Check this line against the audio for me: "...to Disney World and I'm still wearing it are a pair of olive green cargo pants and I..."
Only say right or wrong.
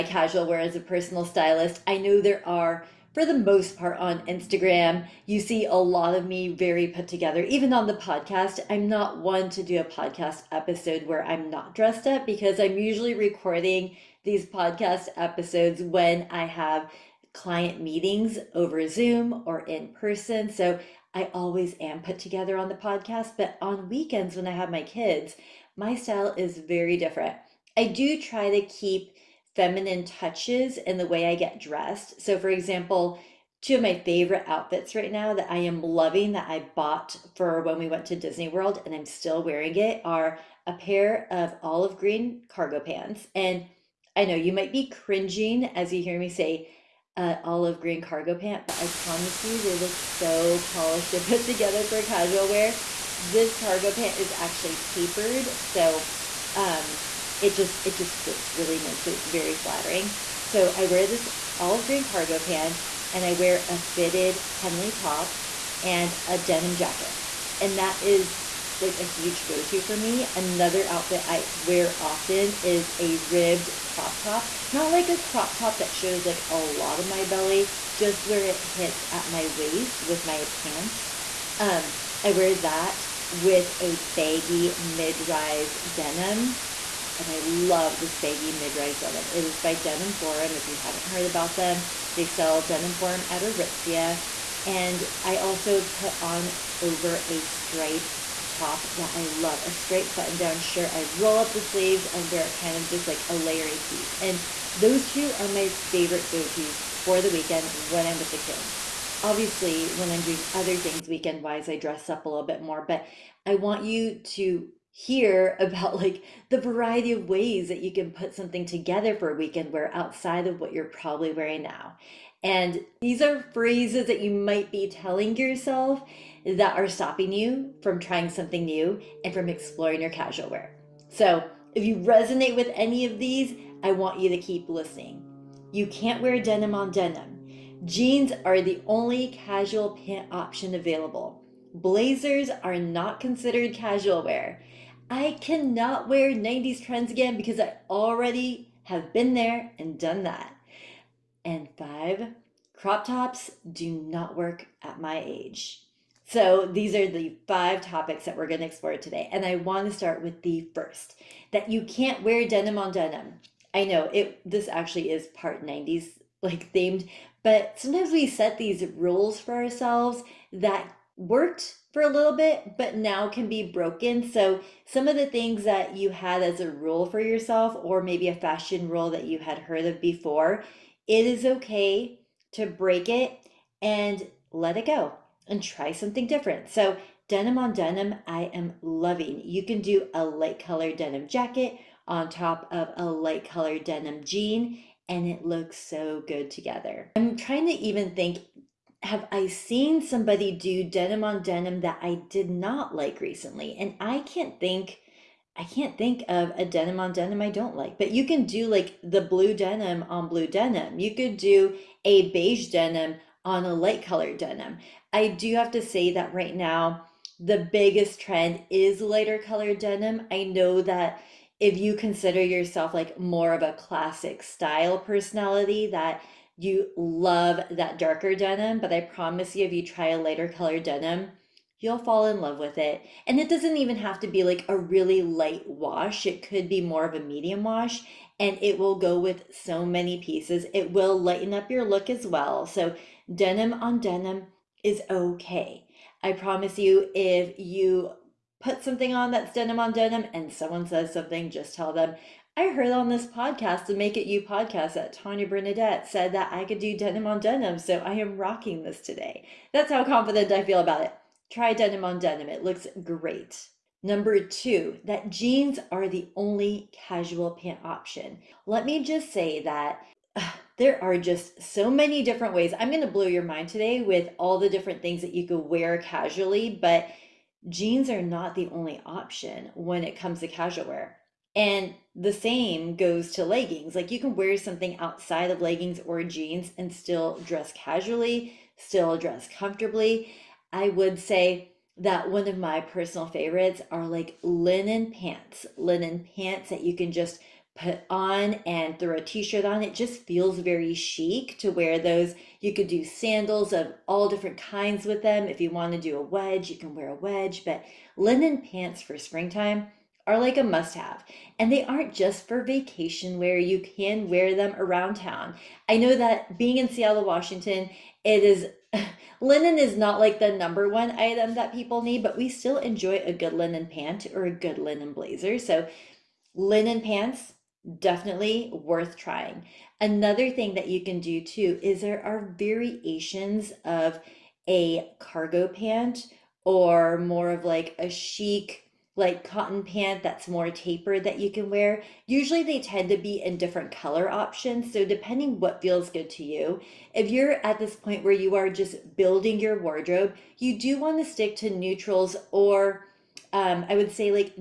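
right.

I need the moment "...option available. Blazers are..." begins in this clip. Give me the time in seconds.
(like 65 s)
140 s.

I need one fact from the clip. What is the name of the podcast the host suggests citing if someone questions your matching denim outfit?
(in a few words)
Make It You.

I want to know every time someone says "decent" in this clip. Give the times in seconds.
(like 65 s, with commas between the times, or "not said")
not said.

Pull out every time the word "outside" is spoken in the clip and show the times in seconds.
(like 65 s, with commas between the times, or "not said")
119 s, 284 s.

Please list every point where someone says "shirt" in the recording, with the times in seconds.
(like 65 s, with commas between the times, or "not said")
100 s, 299 s.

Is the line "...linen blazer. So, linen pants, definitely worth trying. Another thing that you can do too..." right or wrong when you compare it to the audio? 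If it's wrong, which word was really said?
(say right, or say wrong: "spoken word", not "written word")
right.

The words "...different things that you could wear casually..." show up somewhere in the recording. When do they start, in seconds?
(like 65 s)
274 s.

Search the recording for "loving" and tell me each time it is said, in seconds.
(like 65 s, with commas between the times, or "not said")
35 s, 188 s.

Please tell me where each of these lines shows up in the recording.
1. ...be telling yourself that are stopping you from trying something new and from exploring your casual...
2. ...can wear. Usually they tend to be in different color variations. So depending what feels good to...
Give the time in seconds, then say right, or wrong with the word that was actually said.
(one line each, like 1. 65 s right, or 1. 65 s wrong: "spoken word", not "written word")
1. 124 s right
2. 341 s wrong: "options", not "variations".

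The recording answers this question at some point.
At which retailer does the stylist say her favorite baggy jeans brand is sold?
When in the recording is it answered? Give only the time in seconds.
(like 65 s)
93 s.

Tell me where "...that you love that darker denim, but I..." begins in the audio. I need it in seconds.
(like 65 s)
225 s.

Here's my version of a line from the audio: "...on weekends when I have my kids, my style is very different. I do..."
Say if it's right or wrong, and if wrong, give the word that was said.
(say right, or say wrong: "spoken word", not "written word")
right.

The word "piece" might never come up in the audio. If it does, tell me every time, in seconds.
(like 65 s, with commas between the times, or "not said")
103 s, 240 s.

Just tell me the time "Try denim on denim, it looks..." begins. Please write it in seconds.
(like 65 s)
261 s.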